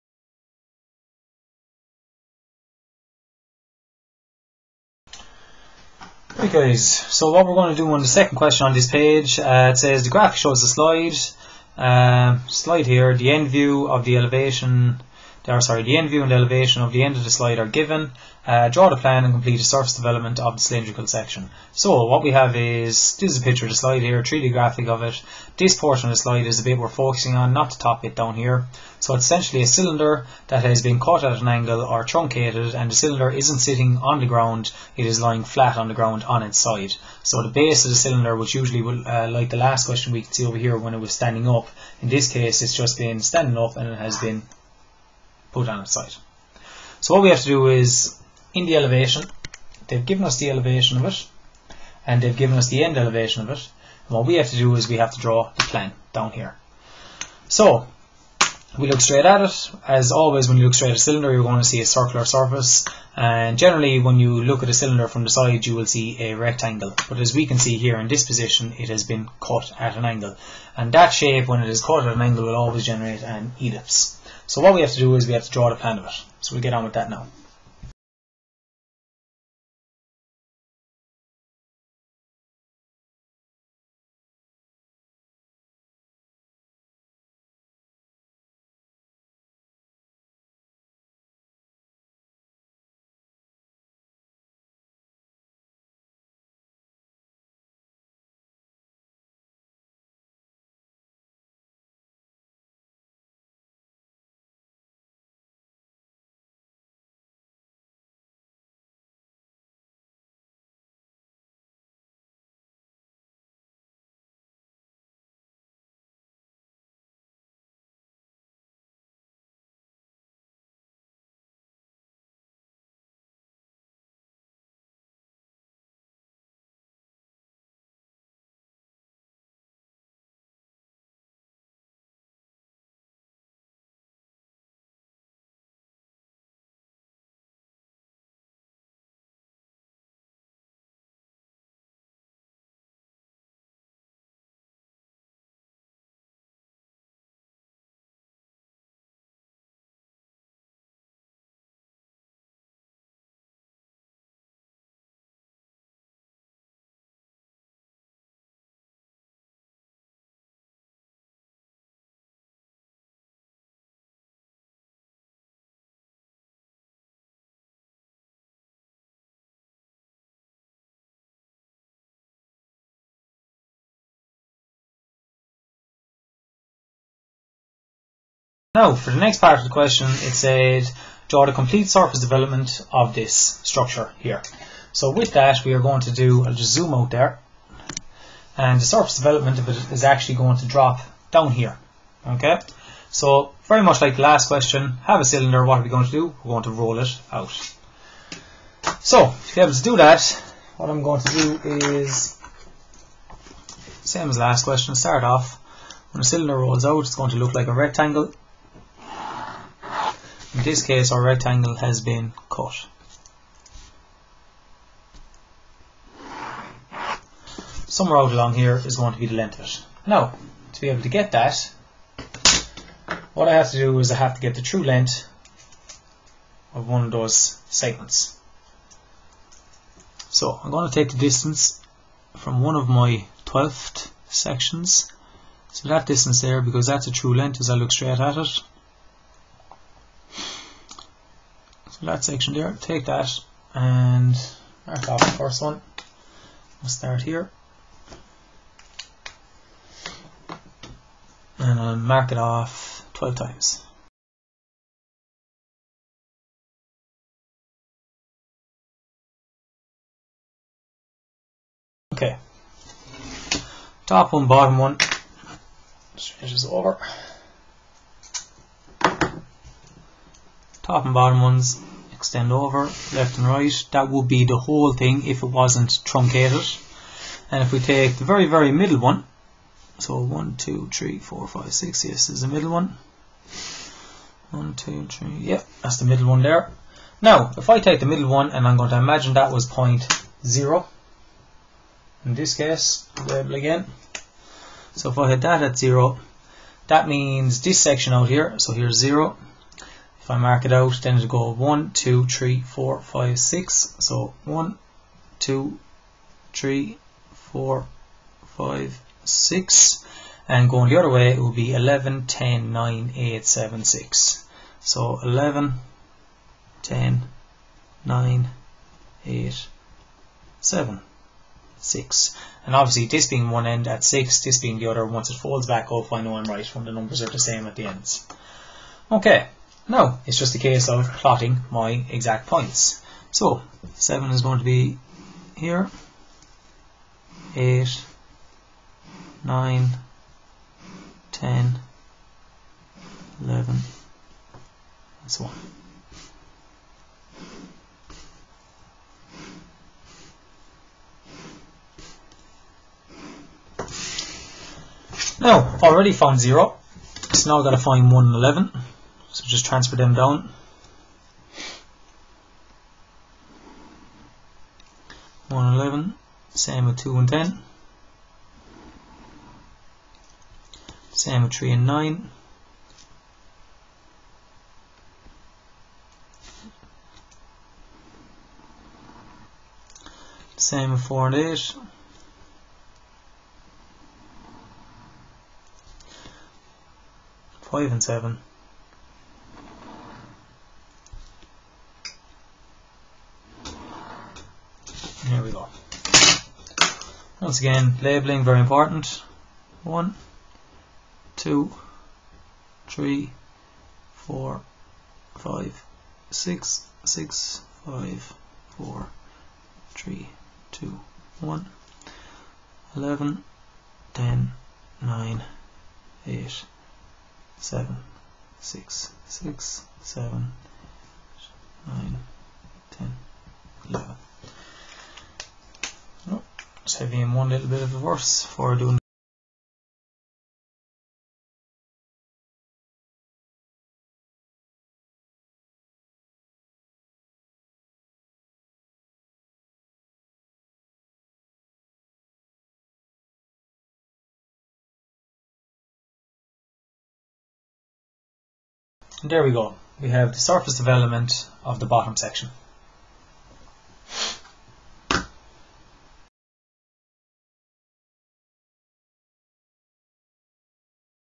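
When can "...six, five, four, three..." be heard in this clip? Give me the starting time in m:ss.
6:47.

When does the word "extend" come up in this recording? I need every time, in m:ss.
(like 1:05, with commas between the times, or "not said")
4:32.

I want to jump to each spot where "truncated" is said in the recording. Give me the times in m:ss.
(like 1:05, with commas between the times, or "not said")
0:32, 4:36.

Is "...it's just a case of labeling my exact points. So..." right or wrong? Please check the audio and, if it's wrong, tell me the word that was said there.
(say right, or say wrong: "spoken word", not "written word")
wrong: "plotting", not "labeling".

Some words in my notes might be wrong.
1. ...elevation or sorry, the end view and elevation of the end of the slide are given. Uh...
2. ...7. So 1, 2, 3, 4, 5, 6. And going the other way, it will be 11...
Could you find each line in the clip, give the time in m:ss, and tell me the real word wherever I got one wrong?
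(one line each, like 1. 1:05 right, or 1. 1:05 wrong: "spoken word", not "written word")
1. 0:14 right
2. 5:03 wrong: "6", not "7".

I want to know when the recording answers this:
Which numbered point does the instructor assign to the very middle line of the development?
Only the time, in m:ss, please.
4:49.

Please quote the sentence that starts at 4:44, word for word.
1, yeah, that's the middle one there.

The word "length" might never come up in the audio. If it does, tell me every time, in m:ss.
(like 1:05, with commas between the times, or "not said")
3:39, 3:44, 3:57.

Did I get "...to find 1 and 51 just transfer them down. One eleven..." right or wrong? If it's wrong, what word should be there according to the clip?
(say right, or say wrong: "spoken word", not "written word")
wrong: "11", not "51".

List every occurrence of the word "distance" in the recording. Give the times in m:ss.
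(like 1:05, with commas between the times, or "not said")
3:51, 3:56.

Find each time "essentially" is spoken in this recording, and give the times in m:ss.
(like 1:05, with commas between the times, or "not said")
0:29.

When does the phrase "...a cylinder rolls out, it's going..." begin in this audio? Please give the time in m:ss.
3:26.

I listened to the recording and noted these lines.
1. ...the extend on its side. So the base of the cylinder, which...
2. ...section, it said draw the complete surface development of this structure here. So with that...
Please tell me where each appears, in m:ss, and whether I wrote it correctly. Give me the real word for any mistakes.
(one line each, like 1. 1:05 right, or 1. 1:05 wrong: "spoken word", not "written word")
1. 0:35 wrong: "ground", not "extend"
2. 2:59 wrong: "question", not "section".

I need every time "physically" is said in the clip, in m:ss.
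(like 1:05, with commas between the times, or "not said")
not said.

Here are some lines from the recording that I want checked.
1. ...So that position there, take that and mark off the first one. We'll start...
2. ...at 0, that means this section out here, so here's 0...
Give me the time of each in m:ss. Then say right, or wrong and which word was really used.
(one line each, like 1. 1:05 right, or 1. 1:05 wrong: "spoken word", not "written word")
1. 4:02 wrong: "section", not "position"
2. 4:55 right.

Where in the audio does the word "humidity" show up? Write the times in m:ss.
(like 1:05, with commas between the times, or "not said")
not said.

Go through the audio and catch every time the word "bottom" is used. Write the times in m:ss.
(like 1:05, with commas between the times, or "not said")
4:24, 4:31, 7:31.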